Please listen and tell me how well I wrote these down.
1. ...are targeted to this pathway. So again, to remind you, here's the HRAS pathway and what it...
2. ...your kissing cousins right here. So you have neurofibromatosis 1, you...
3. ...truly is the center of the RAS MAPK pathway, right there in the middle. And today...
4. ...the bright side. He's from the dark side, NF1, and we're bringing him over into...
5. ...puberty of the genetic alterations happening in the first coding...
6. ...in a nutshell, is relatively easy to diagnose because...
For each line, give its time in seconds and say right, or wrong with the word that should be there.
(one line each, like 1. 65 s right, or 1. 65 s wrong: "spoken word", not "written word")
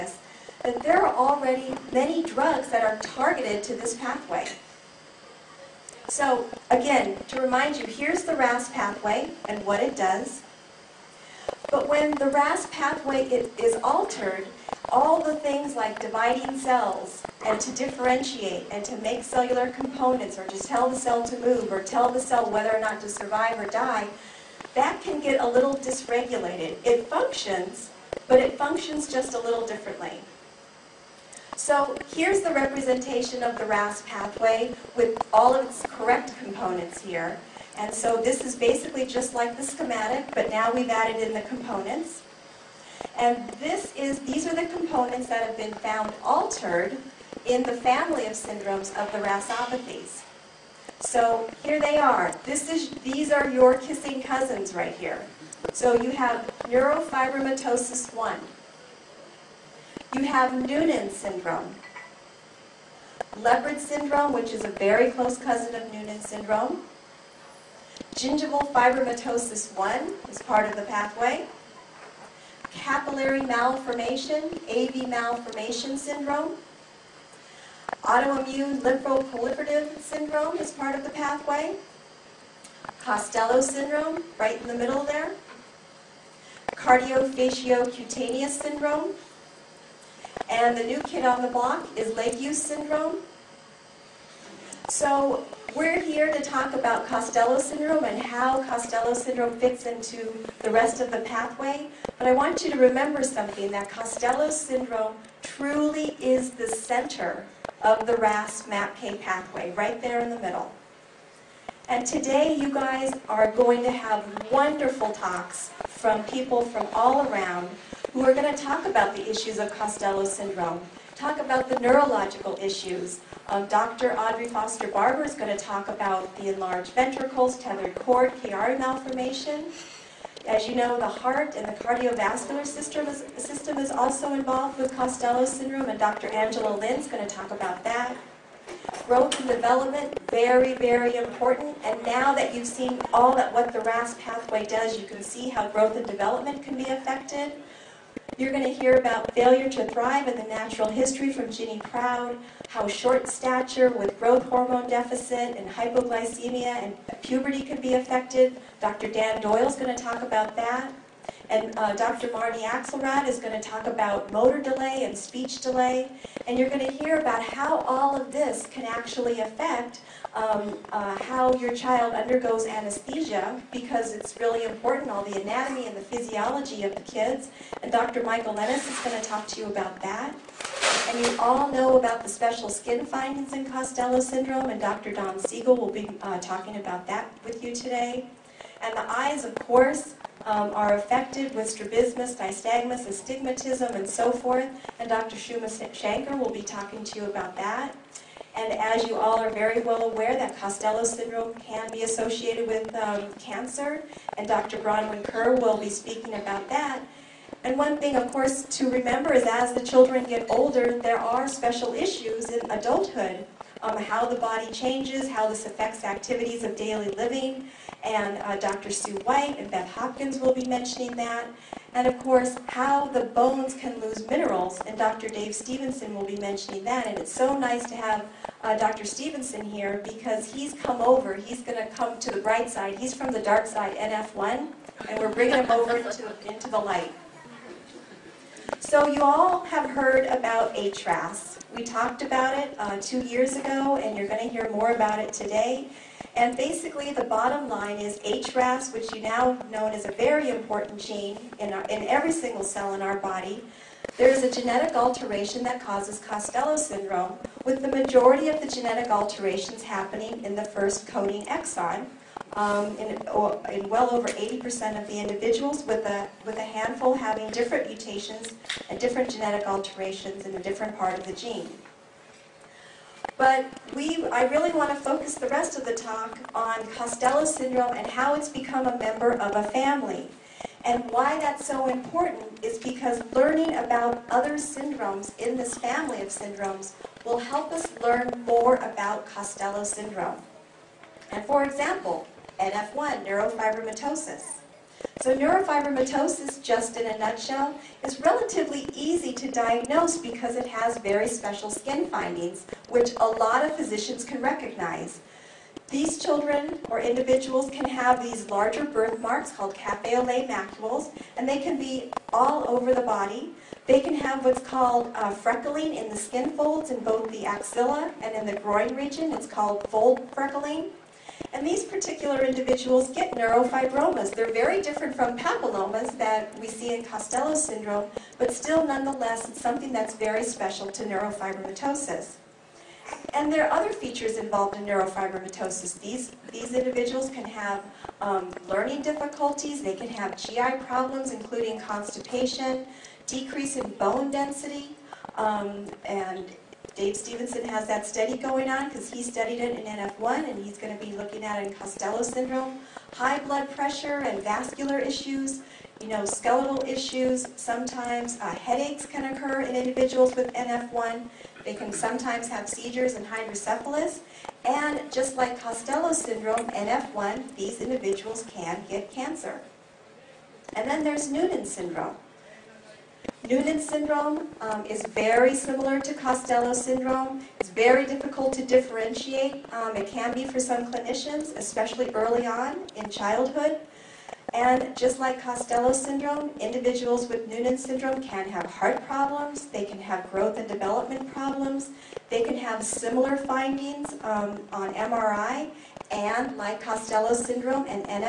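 1. 2 s wrong: "RAS", not "HRAS"
2. 53 s right
3. 105 s right
4. 232 s right
5. 257 s wrong: "majority", not "puberty"
6. 296 s right.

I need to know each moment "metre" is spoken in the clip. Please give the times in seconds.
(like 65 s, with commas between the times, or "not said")
not said.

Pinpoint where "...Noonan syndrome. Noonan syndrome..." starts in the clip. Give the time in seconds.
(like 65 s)
371 s.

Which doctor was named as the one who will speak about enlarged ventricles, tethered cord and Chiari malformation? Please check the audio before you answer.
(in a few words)
Audrey Foster Barber.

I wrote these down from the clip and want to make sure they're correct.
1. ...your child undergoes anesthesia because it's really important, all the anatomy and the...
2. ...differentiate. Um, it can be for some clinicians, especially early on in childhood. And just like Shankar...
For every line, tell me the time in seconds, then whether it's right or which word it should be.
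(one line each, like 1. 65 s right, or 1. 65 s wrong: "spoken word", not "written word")
1. 171 s right
2. 378 s wrong: "Costello", not "Shankar".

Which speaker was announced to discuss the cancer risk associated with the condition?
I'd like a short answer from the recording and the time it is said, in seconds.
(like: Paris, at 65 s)
Dr. Bronwyn Kerr, at 204 s.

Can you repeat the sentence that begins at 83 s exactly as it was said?
Costello syndrome, right in the middle there.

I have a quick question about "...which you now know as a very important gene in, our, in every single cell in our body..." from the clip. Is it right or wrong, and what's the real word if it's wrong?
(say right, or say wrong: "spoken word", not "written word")
right.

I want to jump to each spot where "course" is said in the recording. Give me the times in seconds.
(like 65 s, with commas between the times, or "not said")
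189 s, 208 s, 222 s.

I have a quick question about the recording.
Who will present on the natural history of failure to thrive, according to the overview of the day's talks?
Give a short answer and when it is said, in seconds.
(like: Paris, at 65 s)
Ginny Proud, at 151 s.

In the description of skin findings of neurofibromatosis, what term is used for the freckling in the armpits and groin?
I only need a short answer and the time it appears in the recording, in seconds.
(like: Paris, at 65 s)
fold freckling, at 319 s.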